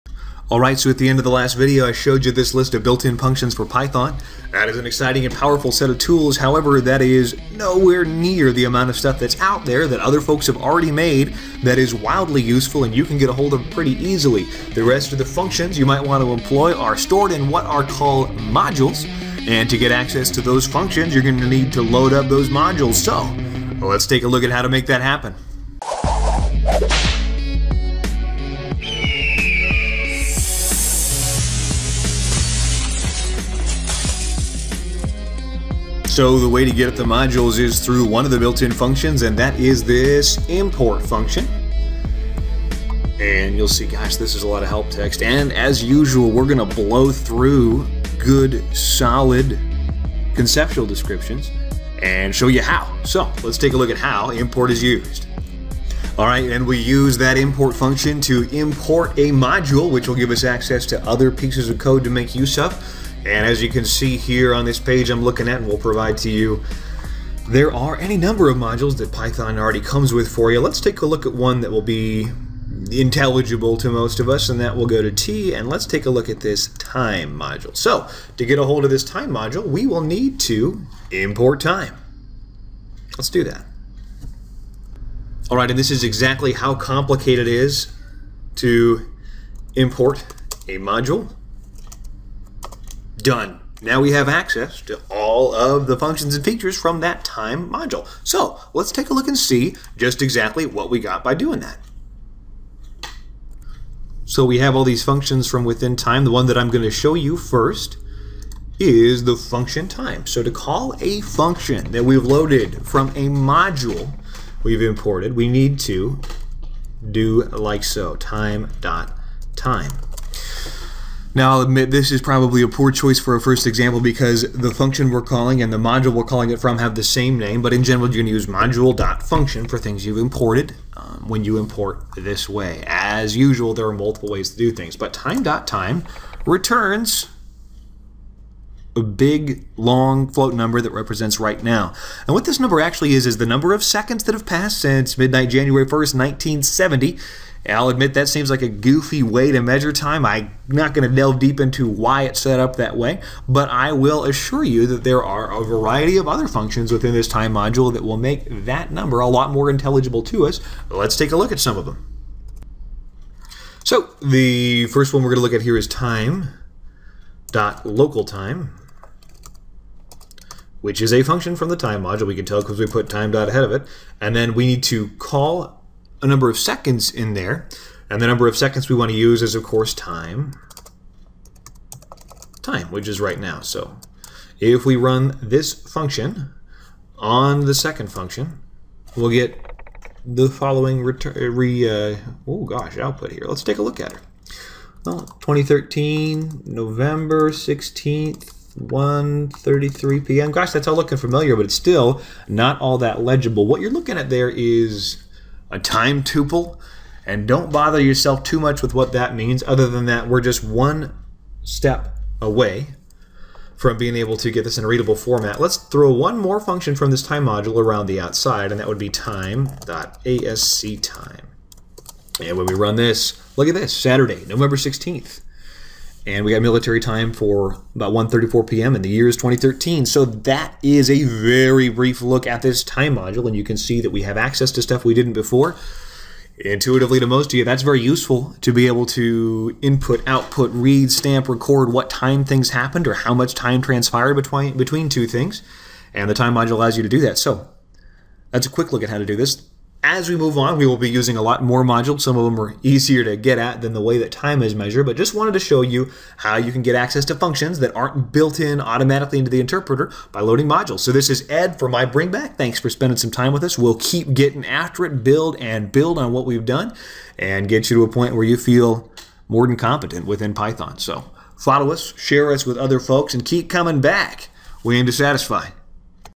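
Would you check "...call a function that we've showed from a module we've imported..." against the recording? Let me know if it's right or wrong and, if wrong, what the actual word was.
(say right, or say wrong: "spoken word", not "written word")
wrong: "loaded", not "showed".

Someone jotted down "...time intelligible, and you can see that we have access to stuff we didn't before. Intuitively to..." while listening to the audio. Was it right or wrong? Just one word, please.
wrong.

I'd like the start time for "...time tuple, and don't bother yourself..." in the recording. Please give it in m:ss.
3:25.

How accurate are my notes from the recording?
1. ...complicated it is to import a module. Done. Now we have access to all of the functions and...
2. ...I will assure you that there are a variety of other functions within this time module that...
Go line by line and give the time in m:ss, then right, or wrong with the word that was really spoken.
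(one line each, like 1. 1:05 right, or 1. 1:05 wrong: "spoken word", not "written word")
1. 1:26 right
2. 2:33 right.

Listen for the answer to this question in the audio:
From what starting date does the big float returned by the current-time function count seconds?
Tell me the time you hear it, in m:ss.
2:25.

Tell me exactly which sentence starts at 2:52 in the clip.
We can tell because we put time dot ahead of it.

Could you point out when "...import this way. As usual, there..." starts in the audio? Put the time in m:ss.
2:11.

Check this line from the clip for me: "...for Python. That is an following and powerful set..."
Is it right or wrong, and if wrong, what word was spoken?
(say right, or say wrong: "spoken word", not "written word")
wrong: "exciting", not "following".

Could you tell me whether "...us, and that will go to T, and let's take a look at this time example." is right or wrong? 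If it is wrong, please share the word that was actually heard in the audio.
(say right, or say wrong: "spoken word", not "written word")
wrong: "module", not "example".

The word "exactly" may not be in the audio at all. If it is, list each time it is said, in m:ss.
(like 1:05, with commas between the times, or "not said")
1:26, 1:40.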